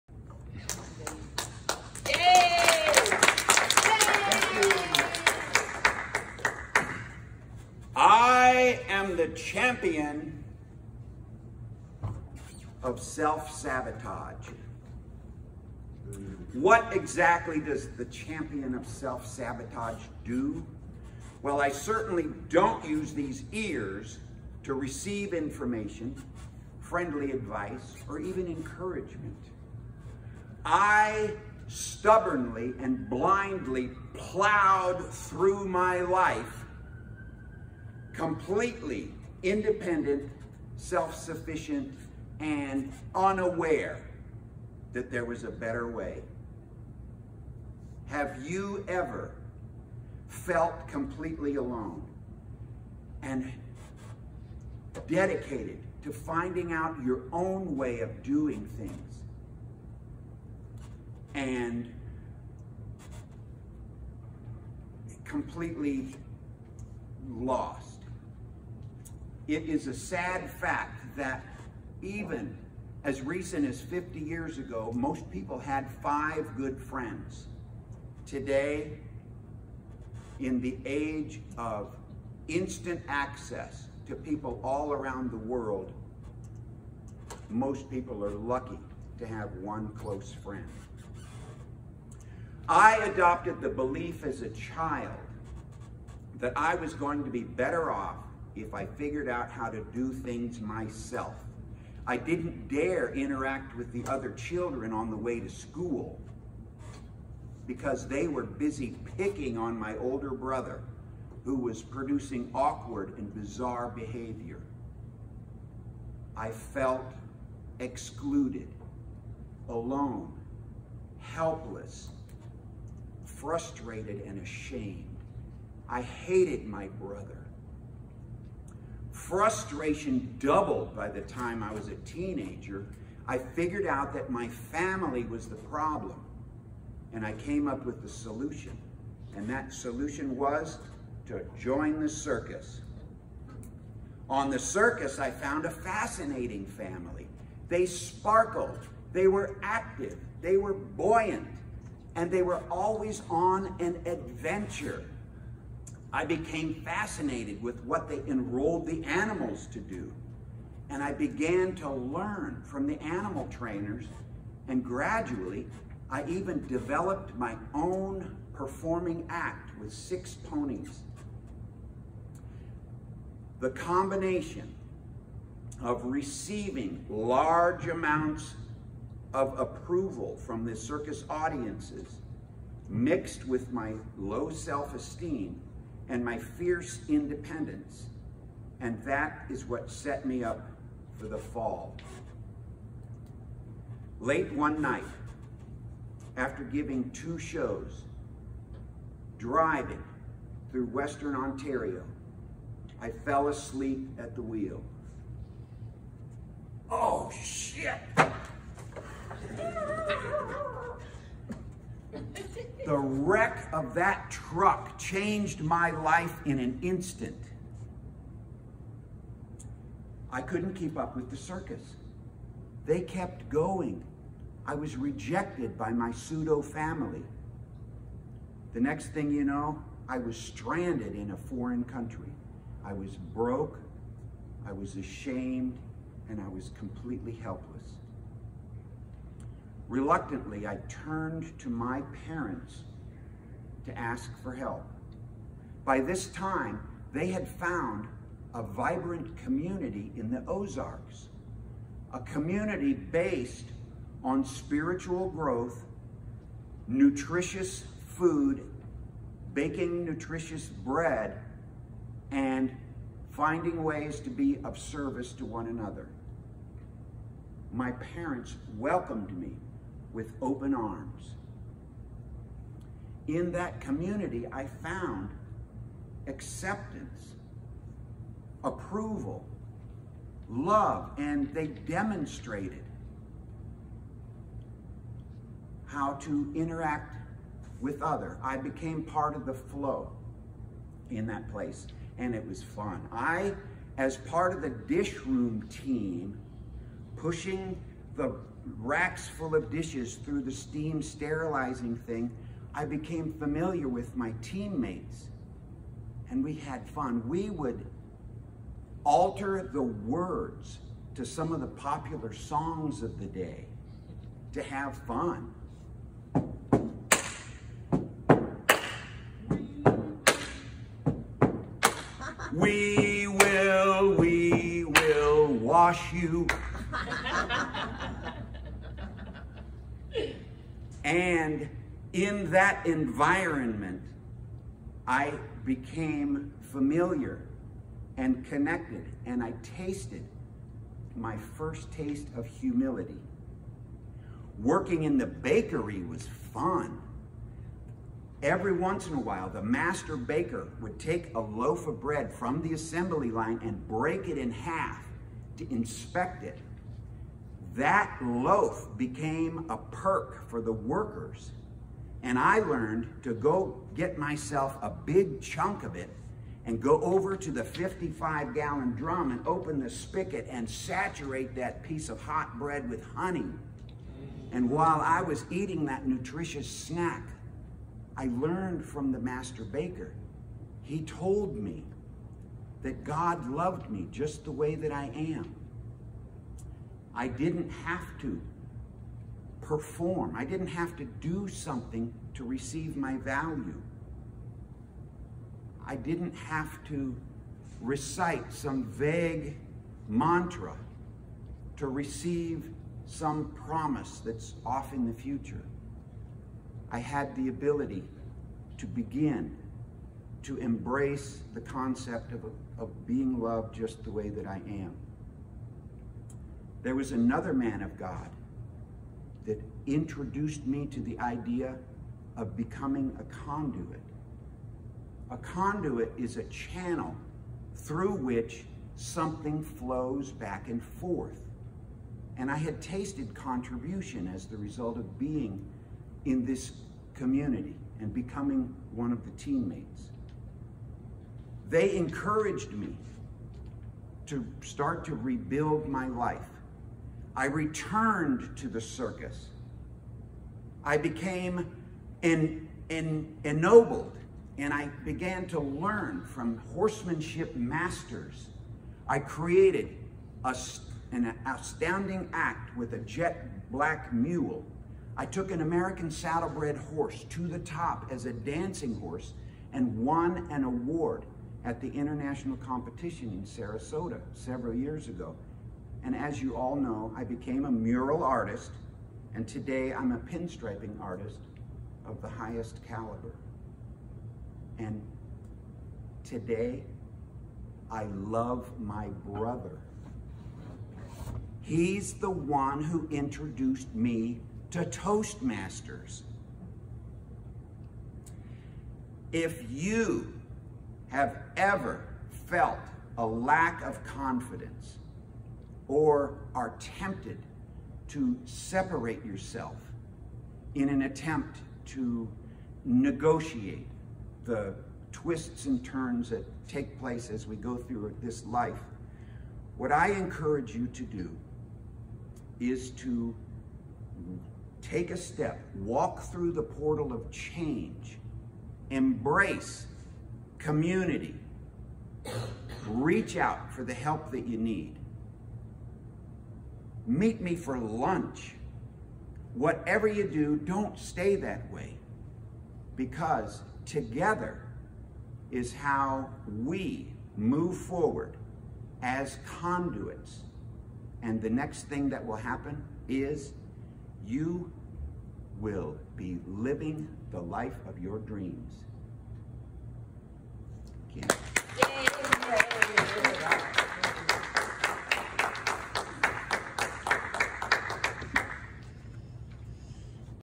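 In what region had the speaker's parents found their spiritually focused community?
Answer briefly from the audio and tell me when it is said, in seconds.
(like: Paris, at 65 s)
The Ozarks, at 250 s.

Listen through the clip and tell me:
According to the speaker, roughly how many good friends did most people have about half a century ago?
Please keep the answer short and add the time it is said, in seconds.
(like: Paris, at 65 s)
5, at 76 s.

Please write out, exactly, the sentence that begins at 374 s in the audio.
And while I was eating that nutritious snack, I learned from the master baker.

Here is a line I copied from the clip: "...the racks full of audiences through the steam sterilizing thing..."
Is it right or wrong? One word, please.
wrong.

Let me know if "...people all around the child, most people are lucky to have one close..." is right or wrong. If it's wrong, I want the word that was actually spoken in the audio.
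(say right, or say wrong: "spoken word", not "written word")
wrong: "world", not "child".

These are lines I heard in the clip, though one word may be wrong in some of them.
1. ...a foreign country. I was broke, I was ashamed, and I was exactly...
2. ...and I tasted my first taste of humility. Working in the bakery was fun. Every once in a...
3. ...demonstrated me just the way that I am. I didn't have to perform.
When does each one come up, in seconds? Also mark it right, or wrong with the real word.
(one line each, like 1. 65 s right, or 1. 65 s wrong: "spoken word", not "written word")
1. 231 s wrong: "completely", not "exactly"
2. 339 s right
3. 383 s wrong: "loved", not "demonstrated".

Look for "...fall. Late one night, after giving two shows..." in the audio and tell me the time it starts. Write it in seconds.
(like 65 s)
191 s.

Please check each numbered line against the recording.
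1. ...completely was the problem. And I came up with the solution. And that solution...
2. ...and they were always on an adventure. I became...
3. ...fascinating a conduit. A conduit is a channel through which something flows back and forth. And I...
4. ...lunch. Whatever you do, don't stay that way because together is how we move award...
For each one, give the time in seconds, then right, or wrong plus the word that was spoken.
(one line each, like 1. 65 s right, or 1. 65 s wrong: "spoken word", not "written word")
1. 134 s wrong: "family", not "completely"
2. 152 s right
3. 422 s wrong: "becoming", not "fascinating"
4. 537 s wrong: "forward", not "award".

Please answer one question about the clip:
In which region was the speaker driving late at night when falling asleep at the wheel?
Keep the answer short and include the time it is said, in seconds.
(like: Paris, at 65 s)
Western Ontario, at 200 s.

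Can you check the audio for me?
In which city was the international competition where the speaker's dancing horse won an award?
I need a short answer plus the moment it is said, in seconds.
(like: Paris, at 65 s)
Sarasota, at 473 s.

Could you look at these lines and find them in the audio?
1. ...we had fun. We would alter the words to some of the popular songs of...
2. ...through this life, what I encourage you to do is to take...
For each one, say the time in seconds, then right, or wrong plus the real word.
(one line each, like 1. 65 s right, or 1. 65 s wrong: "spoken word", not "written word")
1. 306 s right
2. 517 s right.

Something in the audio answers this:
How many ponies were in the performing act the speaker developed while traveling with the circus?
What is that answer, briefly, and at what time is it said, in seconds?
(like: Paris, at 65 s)
6, at 169 s.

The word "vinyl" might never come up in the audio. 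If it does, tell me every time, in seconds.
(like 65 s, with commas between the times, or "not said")
not said.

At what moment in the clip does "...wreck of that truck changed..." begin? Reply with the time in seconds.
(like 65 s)
212 s.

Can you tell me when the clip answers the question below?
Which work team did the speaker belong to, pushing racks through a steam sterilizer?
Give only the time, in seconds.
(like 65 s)
294 s.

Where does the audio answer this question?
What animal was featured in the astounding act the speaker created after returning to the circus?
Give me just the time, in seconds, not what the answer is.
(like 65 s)
462 s.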